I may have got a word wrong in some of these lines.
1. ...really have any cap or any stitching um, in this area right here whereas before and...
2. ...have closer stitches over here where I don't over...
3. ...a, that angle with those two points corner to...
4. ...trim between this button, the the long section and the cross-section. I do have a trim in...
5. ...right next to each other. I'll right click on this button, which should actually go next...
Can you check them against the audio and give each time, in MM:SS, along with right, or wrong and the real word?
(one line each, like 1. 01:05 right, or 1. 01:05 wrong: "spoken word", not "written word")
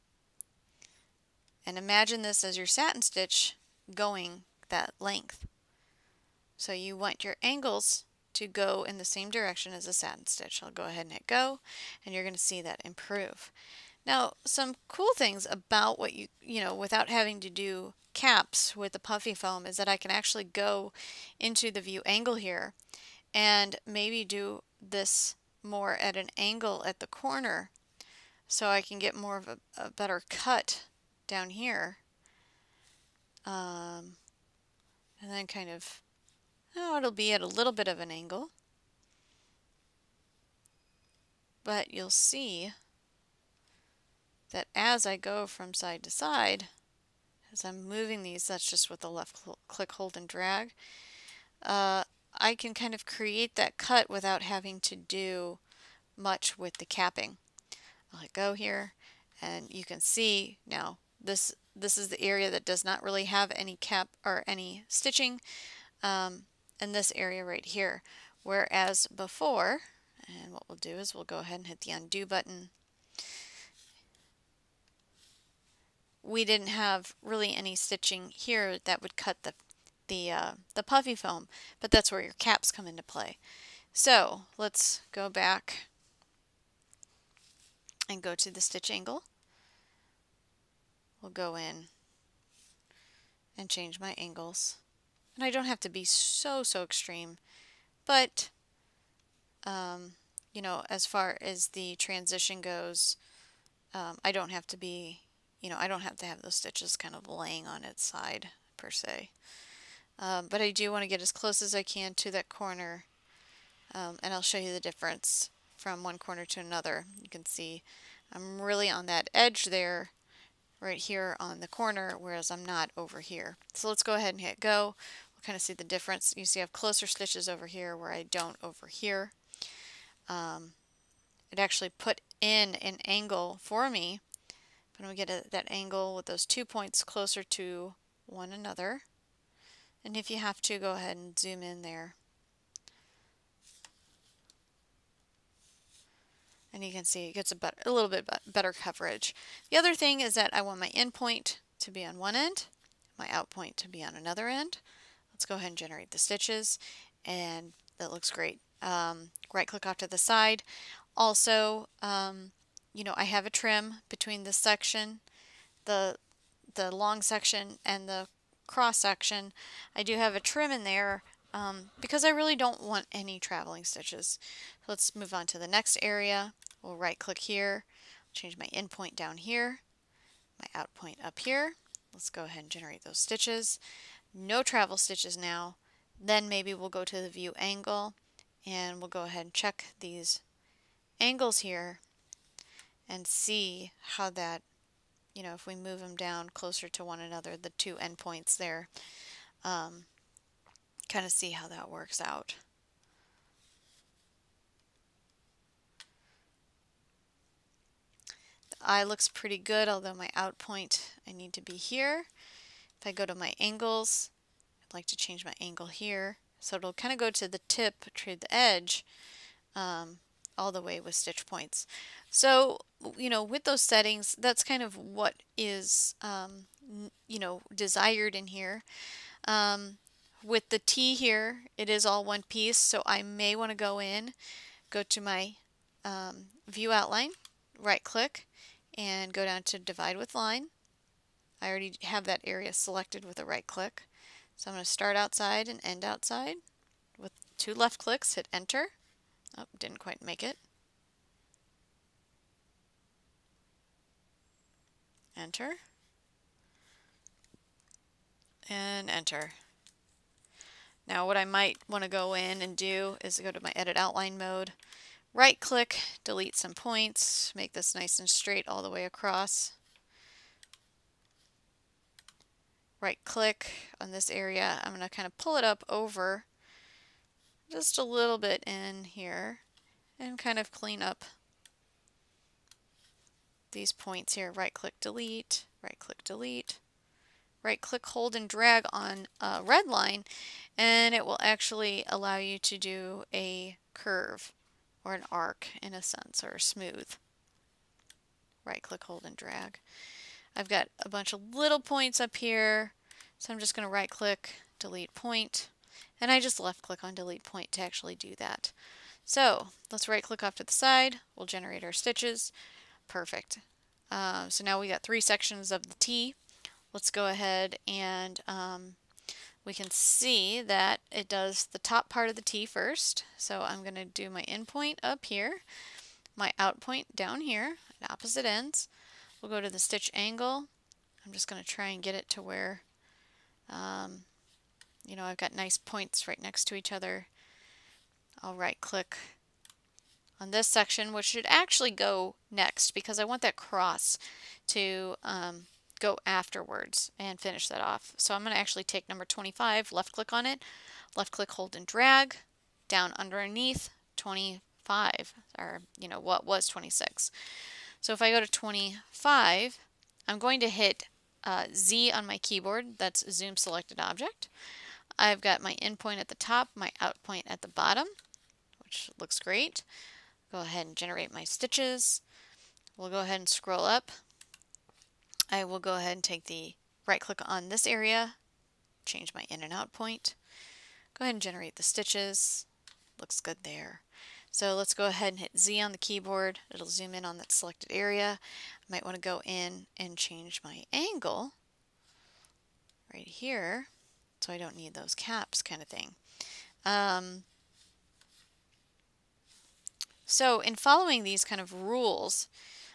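1. 01:03 right
2. 02:06 right
3. 02:15 wrong: "closer", not "corner"
4. 02:43 wrong: "section", not "button"
5. 05:36 wrong: "section", not "button".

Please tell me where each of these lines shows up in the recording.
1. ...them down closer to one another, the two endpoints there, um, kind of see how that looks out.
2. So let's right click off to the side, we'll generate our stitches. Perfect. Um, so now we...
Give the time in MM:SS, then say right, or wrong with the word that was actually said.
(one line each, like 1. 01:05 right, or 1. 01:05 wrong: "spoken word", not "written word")
1. 03:16 wrong: "works", not "looks"
2. 05:09 right.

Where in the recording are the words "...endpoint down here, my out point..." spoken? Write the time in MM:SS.
02:58.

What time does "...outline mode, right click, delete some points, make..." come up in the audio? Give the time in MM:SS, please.
04:23.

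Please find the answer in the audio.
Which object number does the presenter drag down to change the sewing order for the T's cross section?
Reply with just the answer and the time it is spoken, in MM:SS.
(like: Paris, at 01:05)
25, at 05:49.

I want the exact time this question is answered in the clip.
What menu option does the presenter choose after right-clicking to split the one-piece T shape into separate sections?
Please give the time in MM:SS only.
03:59.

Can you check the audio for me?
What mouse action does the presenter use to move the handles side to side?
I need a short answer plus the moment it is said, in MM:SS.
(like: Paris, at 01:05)
left click, hold, and drag, at 00:49.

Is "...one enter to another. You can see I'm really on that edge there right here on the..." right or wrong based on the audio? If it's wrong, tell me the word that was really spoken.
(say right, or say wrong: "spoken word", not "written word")
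wrong: "corner", not "enter".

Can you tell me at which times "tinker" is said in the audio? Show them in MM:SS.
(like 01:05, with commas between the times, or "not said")
not said.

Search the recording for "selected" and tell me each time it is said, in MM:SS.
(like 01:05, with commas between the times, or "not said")
04:02, 06:03, 06:27.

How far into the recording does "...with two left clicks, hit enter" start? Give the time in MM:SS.
04:07.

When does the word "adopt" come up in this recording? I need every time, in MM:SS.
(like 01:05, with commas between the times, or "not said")
not said.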